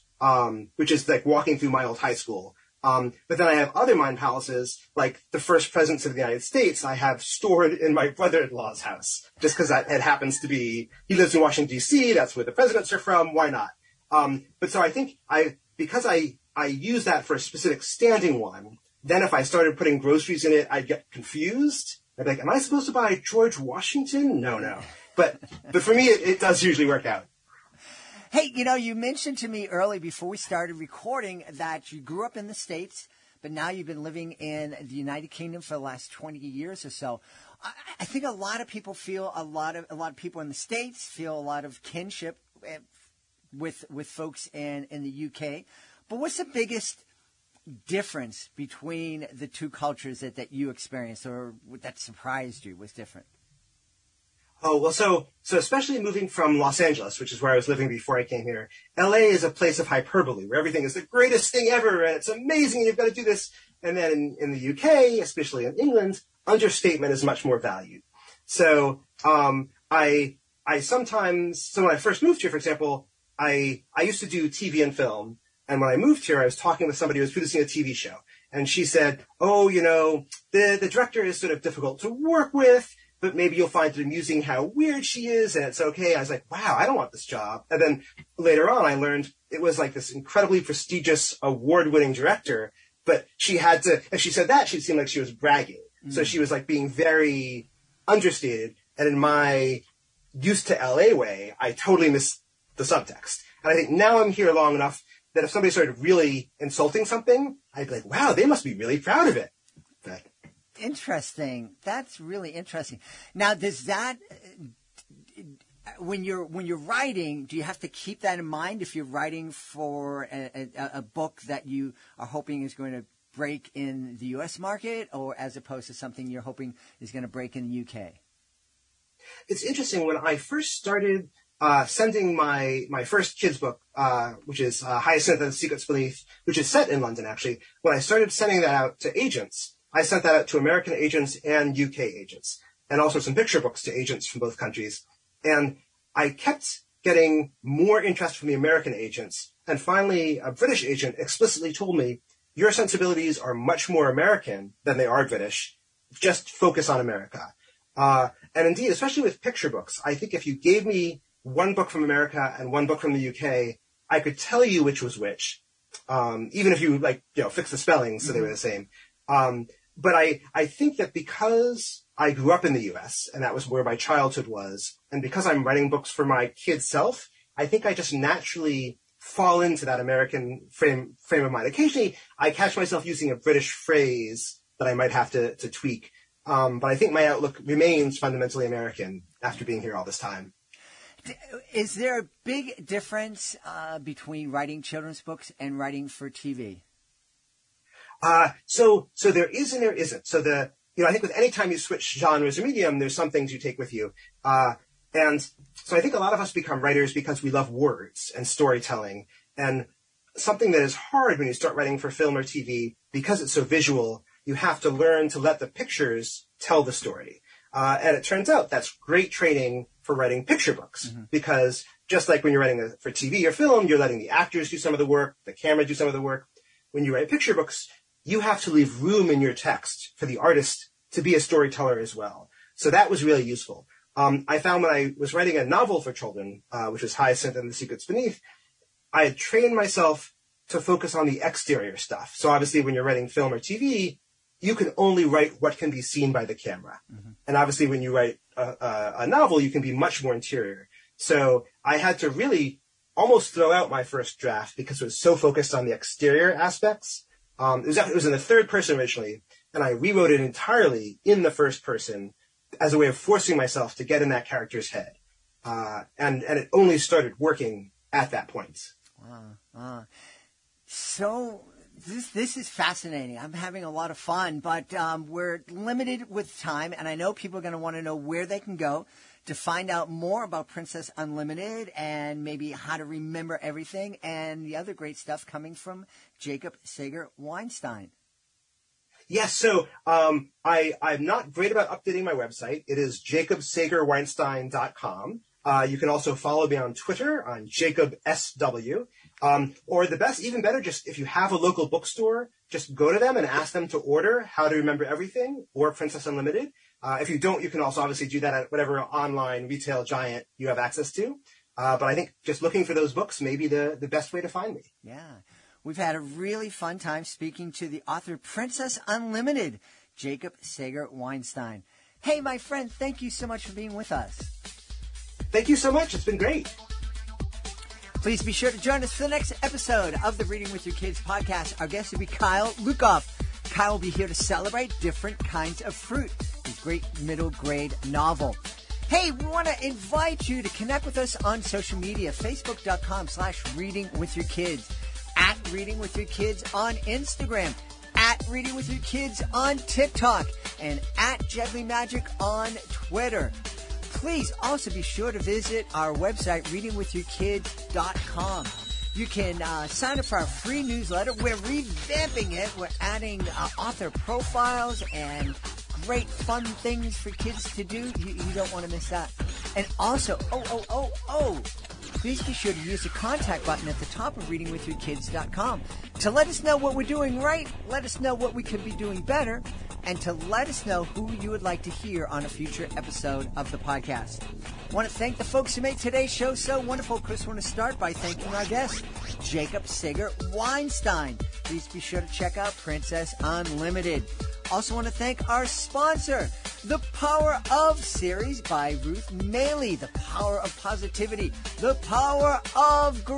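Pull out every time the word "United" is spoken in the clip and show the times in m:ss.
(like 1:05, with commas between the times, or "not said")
0:06, 0:34.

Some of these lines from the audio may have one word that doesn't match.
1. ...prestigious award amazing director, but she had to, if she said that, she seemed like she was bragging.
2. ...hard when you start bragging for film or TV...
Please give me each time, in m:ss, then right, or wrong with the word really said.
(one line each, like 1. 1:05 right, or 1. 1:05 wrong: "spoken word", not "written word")
1. 1:30 wrong: "winning", not "amazing"
2. 3:30 wrong: "writing", not "bragging".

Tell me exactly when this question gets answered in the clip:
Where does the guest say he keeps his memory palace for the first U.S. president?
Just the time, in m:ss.
0:07.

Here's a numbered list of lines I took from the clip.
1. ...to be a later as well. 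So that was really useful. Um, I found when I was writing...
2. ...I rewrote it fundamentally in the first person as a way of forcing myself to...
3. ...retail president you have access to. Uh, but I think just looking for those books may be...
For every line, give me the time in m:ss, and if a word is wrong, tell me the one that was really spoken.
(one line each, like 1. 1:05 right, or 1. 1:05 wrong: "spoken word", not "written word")
1. 3:51 wrong: "storyteller", not "later"
2. 4:19 wrong: "entirely", not "fundamentally"
3. 5:09 wrong: "giant", not "president".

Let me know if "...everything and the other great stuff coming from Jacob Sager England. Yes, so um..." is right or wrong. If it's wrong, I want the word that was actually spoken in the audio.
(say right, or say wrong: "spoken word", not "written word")
wrong: "Weinstein", not "England".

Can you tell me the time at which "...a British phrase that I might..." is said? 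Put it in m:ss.
3:03.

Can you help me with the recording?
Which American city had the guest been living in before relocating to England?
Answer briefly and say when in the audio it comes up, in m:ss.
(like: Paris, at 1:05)
Los Angeles, at 0:56.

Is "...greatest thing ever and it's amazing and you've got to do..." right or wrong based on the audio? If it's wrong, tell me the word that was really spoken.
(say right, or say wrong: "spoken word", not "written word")
right.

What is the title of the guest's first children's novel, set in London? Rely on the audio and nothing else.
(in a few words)
Hyacinth and the Secrets Beneath.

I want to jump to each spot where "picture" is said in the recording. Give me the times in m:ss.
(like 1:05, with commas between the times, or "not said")
2:23, 2:39, 3:35, 3:40, 3:47.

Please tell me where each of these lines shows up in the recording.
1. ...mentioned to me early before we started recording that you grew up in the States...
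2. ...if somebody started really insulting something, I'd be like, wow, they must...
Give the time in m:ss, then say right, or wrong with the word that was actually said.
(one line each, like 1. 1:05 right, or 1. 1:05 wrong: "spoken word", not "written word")
1. 0:28 right
2. 1:45 right.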